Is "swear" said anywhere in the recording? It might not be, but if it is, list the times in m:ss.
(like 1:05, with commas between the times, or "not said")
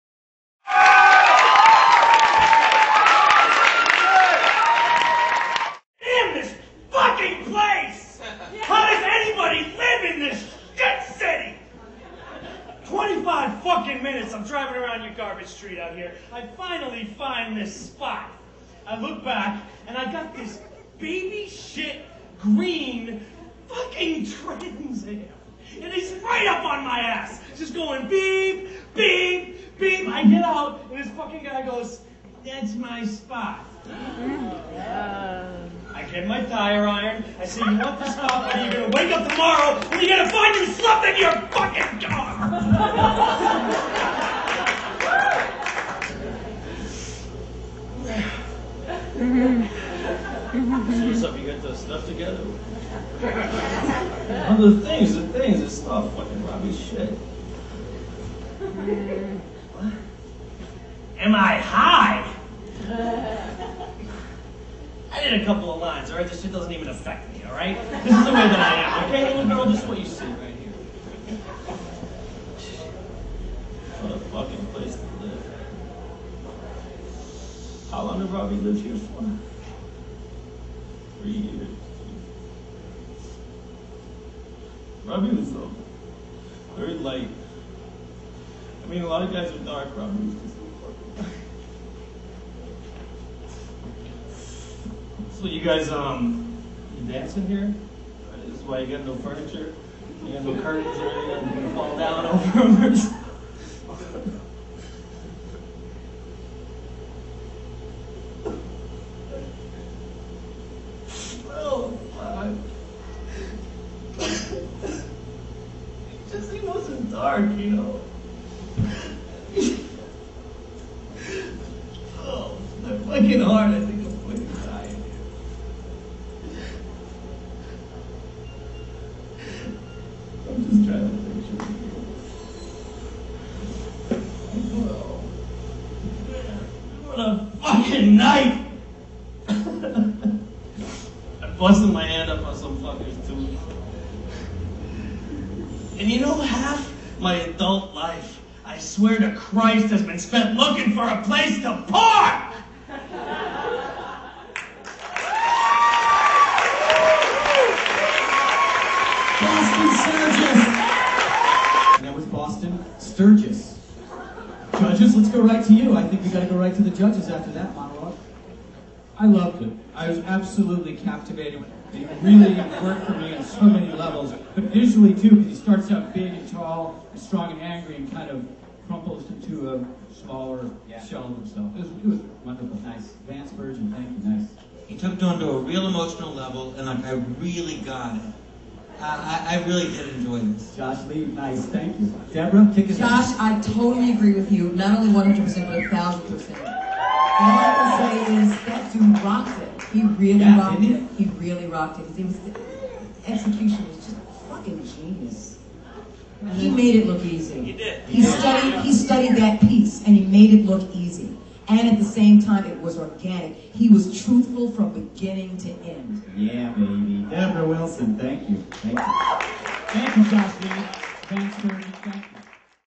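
2:28.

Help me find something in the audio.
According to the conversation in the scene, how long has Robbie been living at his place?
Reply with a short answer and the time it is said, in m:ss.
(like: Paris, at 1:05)
3 years, at 1:21.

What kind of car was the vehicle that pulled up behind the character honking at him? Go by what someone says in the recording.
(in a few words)
Trans Am.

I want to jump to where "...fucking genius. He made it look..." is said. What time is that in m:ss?
3:24.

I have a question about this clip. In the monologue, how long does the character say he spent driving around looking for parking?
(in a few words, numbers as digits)
25 minutes.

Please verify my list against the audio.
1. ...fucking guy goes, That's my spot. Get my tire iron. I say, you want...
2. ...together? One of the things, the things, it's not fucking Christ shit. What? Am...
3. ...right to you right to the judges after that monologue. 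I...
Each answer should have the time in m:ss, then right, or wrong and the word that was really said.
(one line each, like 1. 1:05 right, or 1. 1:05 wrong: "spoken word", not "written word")
1. 0:31 right
2. 0:52 wrong: "Robbie", not "Christ"
3. 2:45 right.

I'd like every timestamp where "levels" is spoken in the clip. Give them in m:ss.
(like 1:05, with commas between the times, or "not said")
2:53, 3:06.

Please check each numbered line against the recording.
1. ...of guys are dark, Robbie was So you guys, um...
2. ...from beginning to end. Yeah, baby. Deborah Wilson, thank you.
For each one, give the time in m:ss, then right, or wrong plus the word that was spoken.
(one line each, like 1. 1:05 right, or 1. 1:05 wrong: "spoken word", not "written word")
1. 1:29 right
2. 3:34 right.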